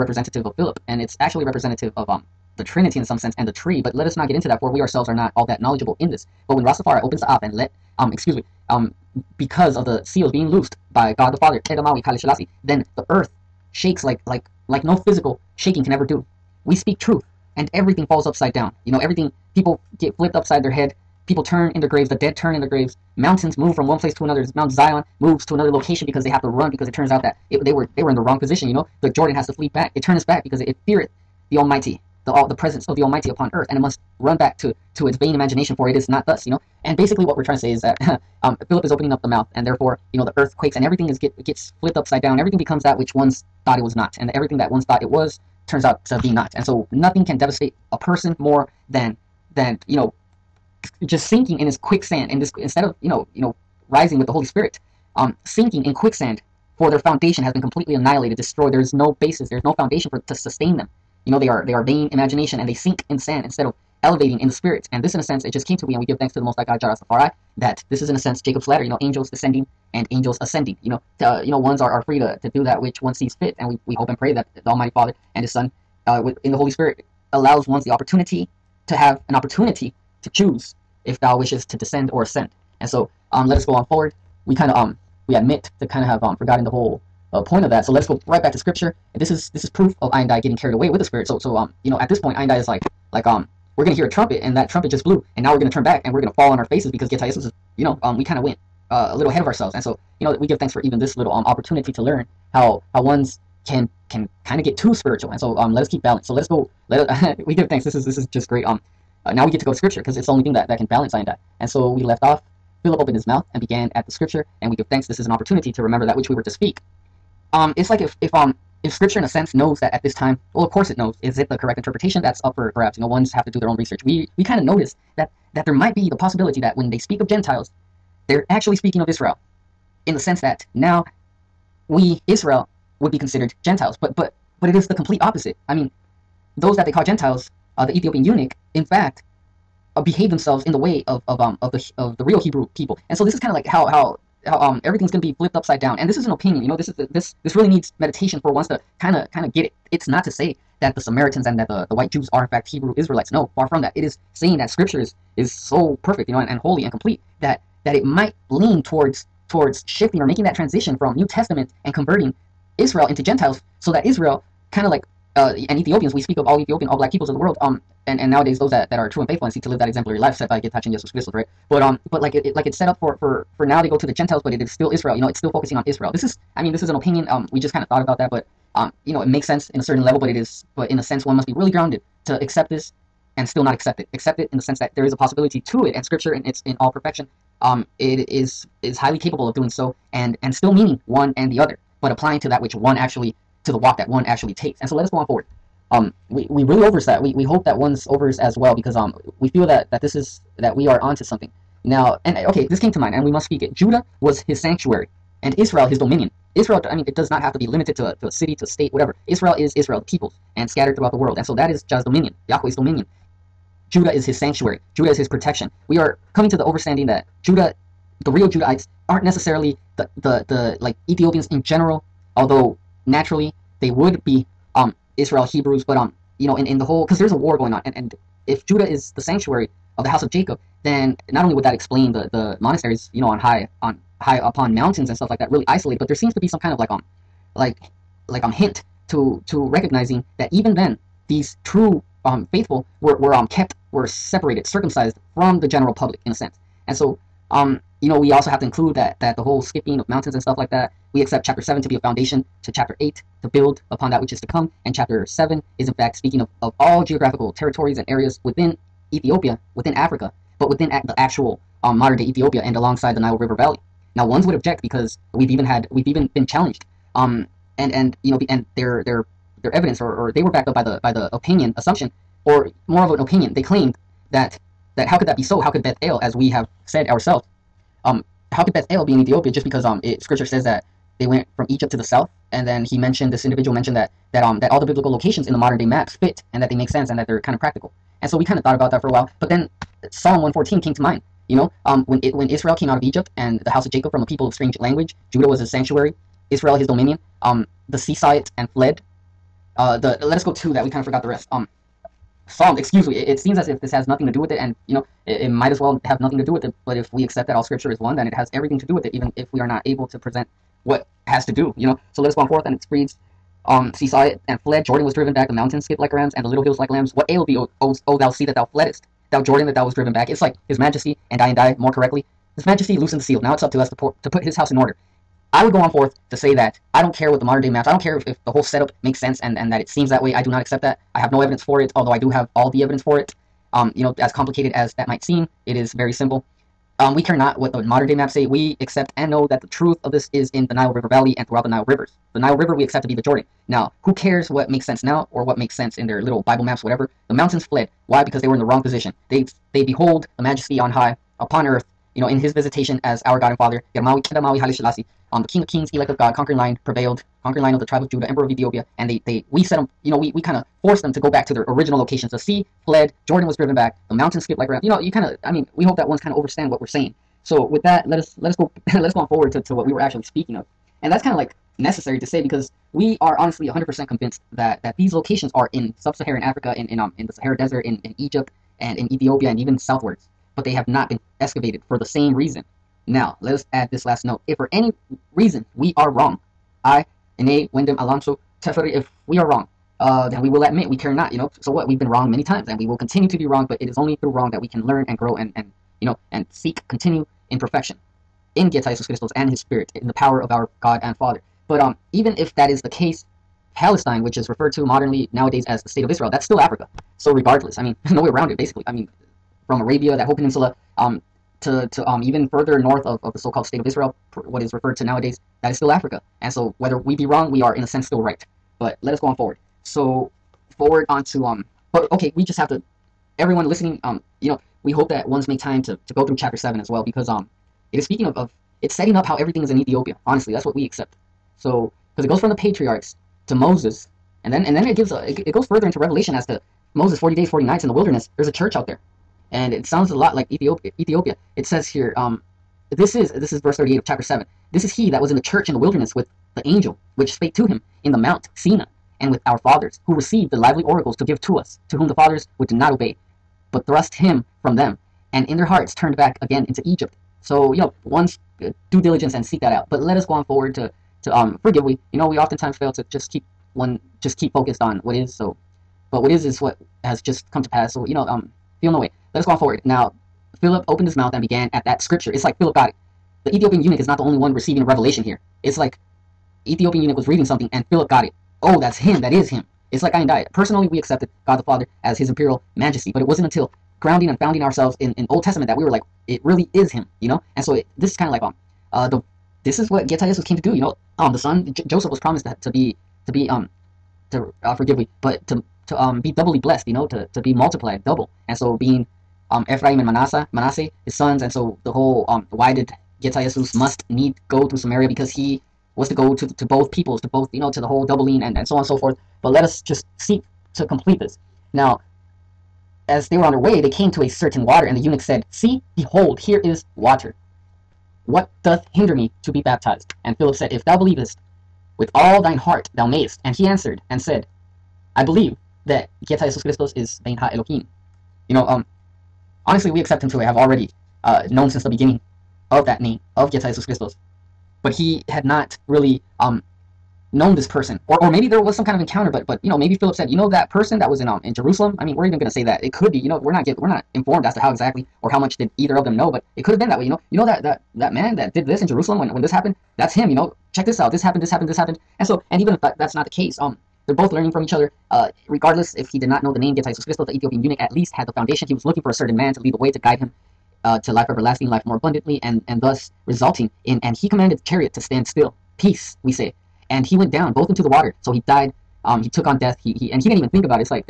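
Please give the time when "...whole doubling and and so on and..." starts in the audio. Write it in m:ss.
8:27.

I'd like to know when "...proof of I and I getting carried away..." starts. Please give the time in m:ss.
1:29.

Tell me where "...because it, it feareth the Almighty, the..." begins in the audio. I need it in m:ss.
0:30.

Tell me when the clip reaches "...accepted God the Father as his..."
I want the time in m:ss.
8:00.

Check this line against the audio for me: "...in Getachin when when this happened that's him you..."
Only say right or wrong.
wrong.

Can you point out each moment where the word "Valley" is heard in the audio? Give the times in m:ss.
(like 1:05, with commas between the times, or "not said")
4:23, 5:41.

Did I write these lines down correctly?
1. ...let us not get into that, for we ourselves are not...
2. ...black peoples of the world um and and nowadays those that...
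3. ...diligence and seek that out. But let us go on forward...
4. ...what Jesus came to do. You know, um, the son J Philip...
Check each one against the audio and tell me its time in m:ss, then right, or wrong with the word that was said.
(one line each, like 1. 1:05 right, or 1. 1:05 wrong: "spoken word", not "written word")
1. 0:03 right
2. 2:46 right
3. 7:39 right
4. 8:09 wrong: "Joseph", not "Philip".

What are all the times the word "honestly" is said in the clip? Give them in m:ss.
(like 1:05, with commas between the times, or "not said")
6:13, 7:10, 8:49.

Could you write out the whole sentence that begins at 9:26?
And he went down both into the water, so he died um, he took on death.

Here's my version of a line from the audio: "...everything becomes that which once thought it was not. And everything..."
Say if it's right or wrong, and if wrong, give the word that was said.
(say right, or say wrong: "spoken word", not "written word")
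right.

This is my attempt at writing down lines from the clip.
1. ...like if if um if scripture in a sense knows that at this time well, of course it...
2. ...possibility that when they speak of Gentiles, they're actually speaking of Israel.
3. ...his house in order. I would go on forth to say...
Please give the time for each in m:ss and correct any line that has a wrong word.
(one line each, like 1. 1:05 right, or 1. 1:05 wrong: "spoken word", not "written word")
1. 1:57 right
2. 2:06 right
3. 5:24 right.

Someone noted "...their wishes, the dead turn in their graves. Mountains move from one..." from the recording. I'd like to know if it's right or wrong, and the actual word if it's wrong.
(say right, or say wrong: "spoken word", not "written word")
wrong: "graves", not "wishes".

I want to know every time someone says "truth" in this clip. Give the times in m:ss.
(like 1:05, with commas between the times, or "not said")
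0:16, 5:39.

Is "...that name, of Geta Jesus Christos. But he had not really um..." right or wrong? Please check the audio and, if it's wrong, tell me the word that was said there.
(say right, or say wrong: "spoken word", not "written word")
right.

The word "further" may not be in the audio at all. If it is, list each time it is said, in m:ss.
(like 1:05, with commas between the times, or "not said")
6:52, 7:15.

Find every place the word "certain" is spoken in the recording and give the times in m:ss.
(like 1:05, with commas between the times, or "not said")
2:59, 8:34, 9:19.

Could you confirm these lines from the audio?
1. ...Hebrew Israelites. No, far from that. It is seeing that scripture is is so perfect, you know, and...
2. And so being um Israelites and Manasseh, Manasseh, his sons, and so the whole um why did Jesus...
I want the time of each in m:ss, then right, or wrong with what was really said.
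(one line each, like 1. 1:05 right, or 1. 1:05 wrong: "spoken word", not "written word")
1. 2:32 right
2. 8:18 wrong: "Ephraim", not "Israelites".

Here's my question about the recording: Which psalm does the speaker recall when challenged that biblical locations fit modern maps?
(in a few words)
Psalm 114.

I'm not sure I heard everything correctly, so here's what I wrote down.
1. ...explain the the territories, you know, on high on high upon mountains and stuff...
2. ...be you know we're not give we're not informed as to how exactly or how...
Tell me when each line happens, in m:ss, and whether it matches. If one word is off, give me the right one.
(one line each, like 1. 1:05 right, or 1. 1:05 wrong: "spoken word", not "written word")
1. 3:51 wrong: "monasteries", not "territories"
2. 9:03 right.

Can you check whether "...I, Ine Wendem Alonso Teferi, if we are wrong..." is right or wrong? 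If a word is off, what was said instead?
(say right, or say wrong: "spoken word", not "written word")
right.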